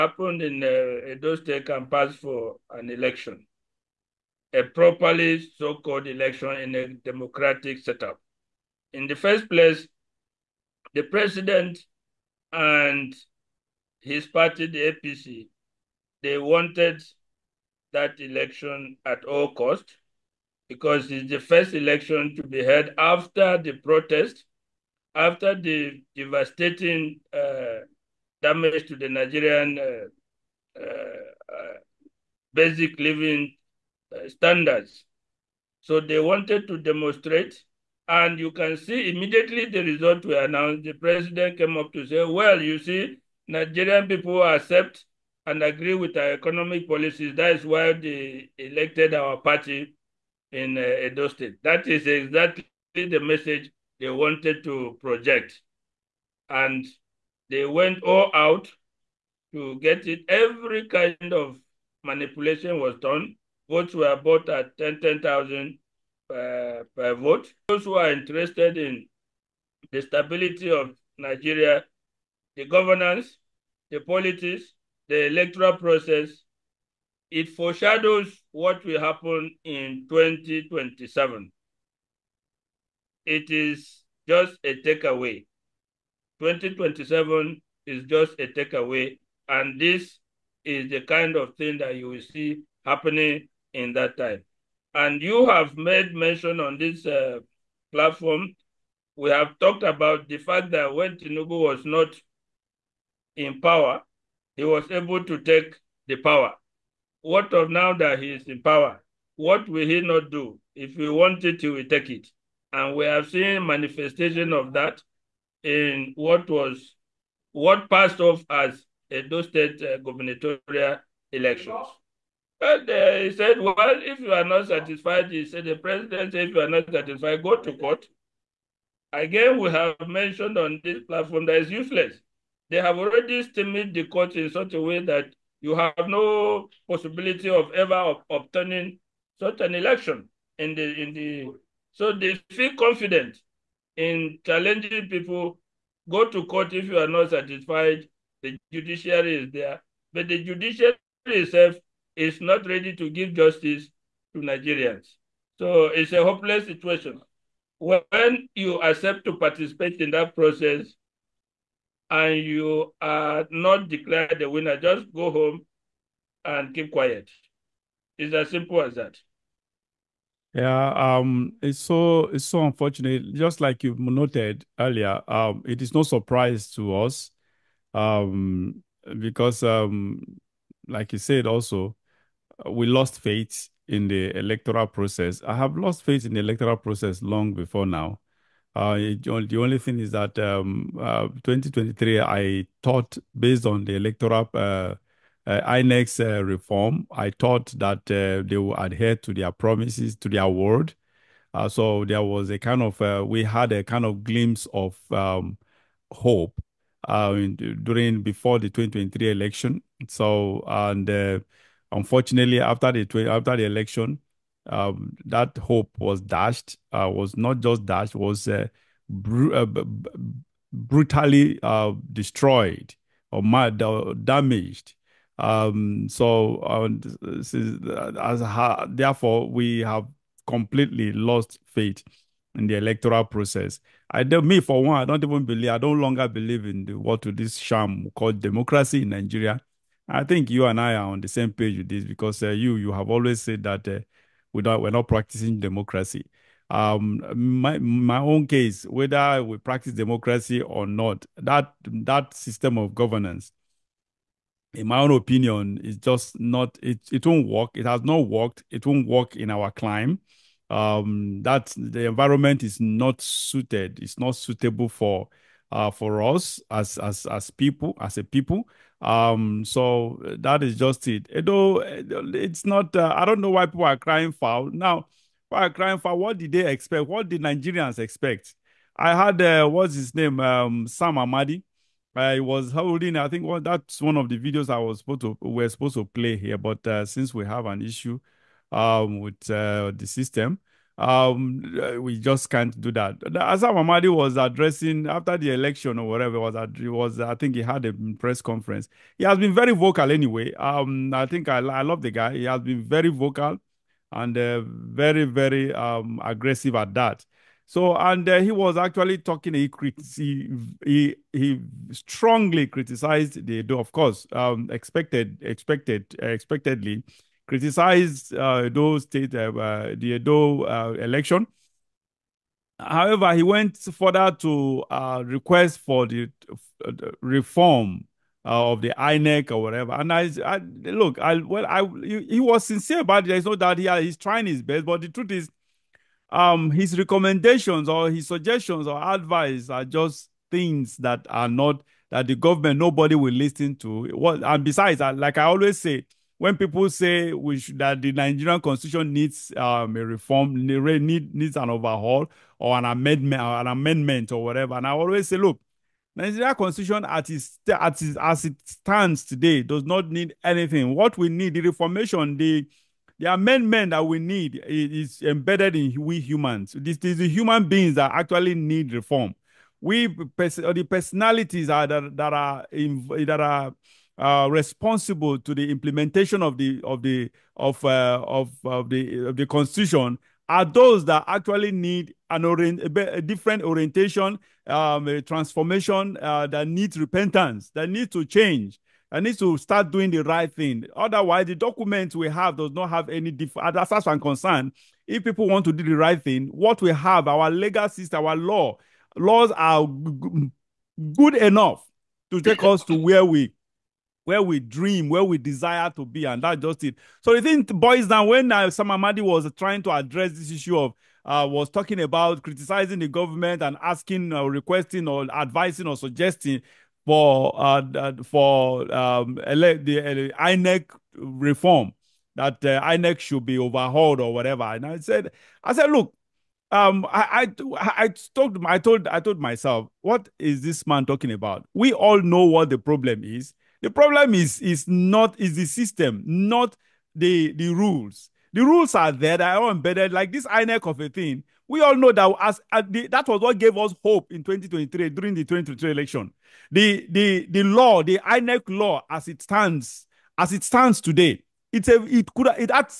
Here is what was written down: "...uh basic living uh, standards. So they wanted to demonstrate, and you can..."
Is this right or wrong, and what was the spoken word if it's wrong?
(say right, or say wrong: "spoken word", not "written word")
right.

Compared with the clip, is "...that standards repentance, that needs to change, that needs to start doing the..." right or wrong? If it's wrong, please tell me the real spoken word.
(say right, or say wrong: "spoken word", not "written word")
wrong: "needs", not "standards".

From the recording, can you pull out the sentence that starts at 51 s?
That is exactly the message they wanted to project.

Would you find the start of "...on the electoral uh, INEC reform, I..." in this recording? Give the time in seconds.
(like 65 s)
193 s.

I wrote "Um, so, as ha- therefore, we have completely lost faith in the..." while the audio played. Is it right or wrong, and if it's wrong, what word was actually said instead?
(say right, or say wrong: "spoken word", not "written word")
right.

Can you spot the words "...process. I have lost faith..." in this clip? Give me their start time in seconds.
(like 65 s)
184 s.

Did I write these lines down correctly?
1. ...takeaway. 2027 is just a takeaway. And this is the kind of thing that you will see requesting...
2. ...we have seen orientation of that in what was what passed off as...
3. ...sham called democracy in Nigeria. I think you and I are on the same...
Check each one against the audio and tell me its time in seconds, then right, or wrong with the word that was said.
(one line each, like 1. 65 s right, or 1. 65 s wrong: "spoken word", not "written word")
1. 84 s wrong: "happening", not "requesting"
2. 112 s wrong: "manifestation", not "orientation"
3. 237 s right.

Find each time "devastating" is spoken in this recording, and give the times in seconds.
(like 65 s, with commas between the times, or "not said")
26 s.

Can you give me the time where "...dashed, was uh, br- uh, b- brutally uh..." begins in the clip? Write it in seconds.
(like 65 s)
217 s.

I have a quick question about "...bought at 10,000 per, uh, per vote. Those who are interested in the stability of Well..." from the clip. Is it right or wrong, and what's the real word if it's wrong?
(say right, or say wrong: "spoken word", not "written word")
wrong: "Nigeria", not "Well".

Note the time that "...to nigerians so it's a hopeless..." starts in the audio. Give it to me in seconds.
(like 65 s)
154 s.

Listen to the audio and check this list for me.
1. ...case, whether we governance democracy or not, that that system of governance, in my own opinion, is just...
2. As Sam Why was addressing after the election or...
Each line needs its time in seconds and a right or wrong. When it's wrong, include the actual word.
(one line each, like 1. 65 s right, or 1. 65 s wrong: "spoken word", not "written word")
1. 248 s wrong: "practice", not "governance"
2. 293 s wrong: "Amadi", not "Why".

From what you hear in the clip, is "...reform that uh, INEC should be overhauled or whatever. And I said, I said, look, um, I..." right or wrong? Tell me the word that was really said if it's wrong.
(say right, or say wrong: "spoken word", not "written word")
right.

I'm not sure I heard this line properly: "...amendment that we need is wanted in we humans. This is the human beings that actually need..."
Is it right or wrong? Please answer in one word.
wrong.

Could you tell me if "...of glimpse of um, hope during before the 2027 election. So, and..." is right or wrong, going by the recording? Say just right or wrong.
wrong.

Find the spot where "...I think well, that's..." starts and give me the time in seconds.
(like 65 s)
283 s.